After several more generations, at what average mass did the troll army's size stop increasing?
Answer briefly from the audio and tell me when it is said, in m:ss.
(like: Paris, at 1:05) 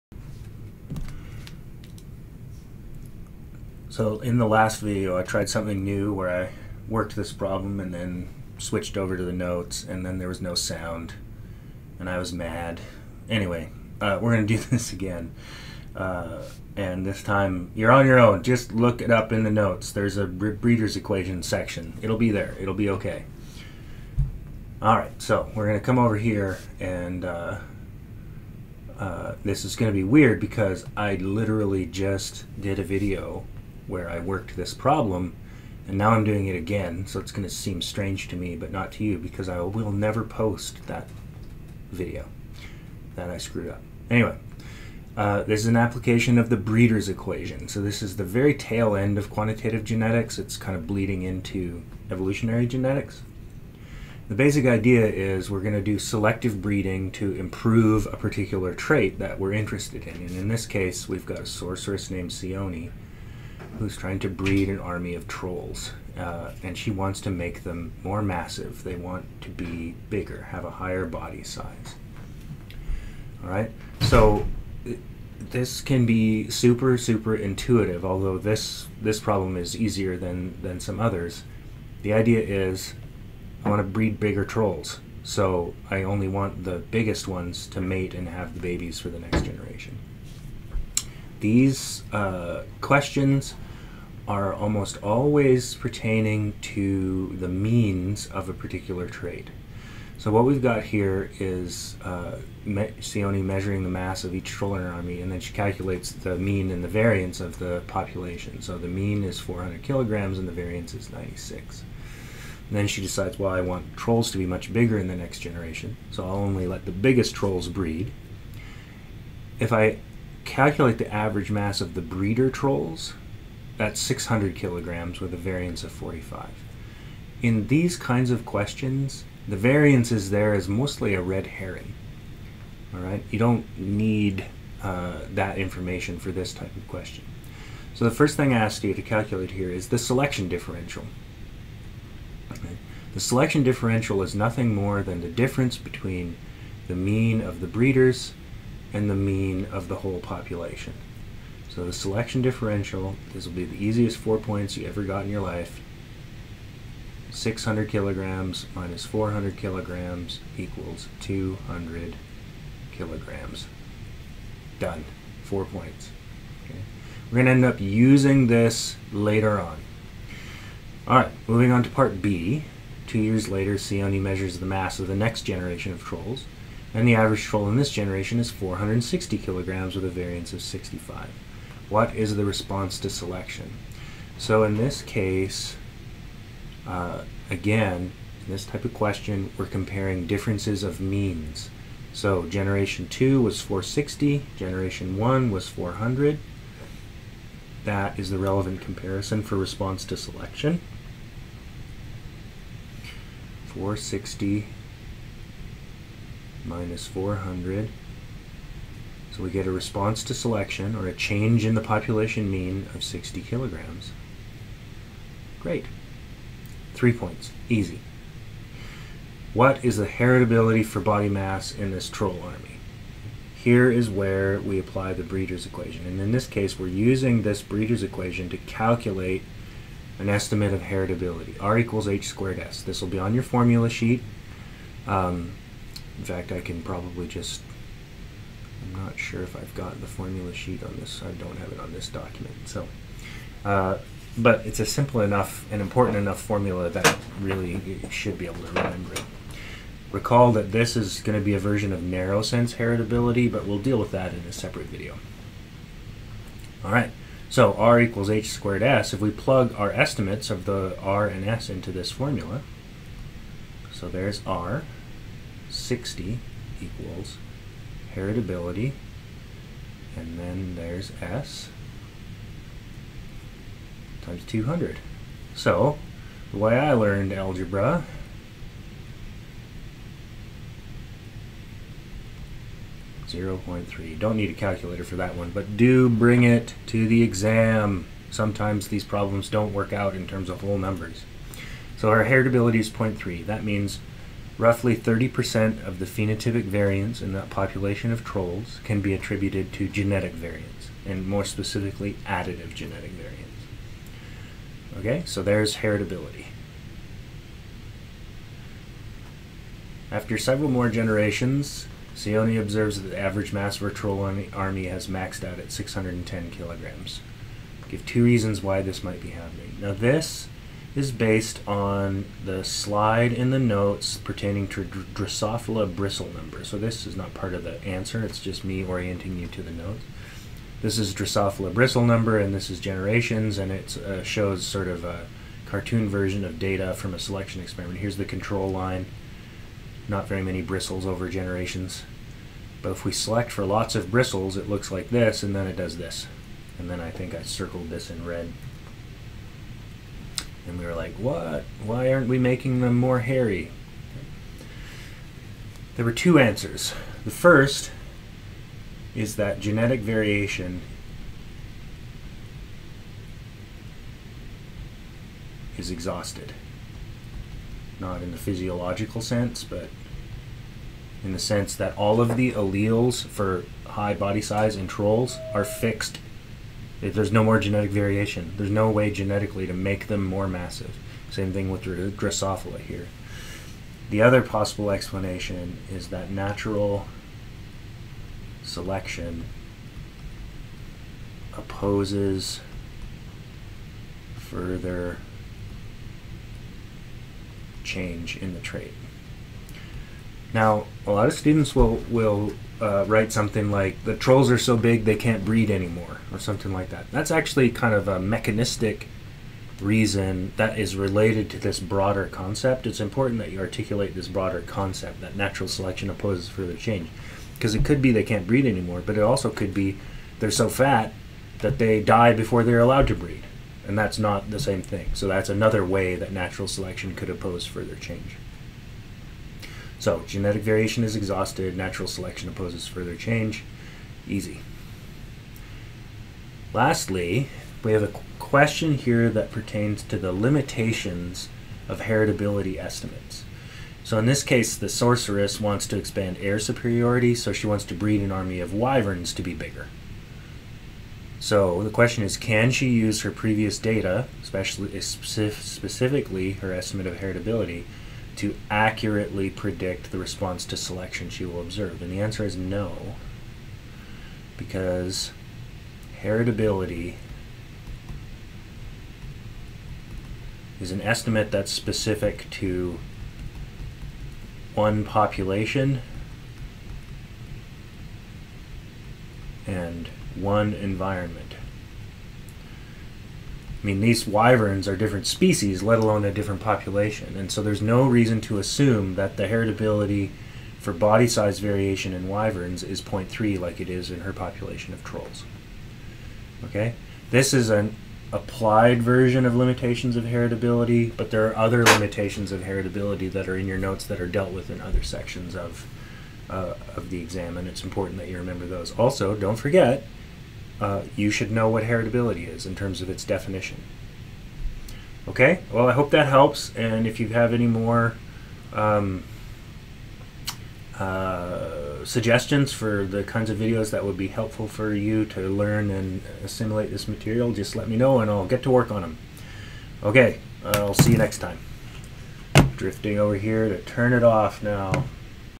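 610 kilograms, at 5:15.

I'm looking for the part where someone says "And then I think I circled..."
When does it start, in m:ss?
5:46.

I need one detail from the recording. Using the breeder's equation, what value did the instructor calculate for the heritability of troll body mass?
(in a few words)
0.3.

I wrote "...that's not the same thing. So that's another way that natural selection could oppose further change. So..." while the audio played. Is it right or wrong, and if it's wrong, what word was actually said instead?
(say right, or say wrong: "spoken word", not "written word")
right.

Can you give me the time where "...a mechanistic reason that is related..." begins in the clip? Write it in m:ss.
6:48.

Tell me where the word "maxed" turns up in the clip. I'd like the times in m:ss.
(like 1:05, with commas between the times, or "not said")
5:15.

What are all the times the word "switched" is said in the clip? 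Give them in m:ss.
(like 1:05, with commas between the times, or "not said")
0:08.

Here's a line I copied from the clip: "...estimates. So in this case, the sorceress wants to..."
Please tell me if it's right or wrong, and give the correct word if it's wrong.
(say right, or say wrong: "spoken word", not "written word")
right.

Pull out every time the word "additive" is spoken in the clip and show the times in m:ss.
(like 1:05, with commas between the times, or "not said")
5:02.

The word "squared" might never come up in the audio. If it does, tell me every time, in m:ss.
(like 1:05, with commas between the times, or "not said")
3:52, 4:18.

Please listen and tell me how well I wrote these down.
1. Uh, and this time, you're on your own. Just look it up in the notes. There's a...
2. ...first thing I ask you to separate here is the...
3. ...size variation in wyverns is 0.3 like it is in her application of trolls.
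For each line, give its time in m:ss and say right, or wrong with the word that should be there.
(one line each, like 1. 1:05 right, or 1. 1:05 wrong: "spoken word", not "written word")
1. 0:15 right
2. 2:18 wrong: "calculate", not "separate"
3. 8:11 wrong: "population", not "application".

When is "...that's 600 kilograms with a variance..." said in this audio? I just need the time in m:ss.
2:03.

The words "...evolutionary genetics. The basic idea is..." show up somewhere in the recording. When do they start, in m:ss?
0:52.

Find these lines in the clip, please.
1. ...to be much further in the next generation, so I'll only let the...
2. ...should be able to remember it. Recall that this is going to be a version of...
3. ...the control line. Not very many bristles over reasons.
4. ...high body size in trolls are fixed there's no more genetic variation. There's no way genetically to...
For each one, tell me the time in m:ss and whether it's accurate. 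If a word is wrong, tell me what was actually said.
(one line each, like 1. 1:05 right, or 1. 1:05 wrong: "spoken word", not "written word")
1. 1:54 wrong: "bigger", not "further"
2. 4:08 right
3. 5:38 wrong: "generations", not "reasons"
4. 6:13 right.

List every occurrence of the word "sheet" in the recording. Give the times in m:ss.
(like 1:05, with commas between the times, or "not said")
3:53, 4:00.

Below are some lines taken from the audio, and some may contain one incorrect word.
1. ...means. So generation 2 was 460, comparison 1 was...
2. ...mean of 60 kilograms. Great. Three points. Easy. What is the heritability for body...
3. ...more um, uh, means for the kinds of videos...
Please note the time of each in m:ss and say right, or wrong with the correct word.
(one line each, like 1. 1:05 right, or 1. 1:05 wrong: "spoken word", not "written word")
1. 3:11 wrong: "generation", not "comparison"
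2. 3:32 right
3. 8:37 wrong: "suggestions", not "means".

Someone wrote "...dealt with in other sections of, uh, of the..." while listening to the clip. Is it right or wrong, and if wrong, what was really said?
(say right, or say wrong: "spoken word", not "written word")
right.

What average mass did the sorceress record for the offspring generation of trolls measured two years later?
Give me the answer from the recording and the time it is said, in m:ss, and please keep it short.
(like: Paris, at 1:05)
460 kilograms, at 2:58.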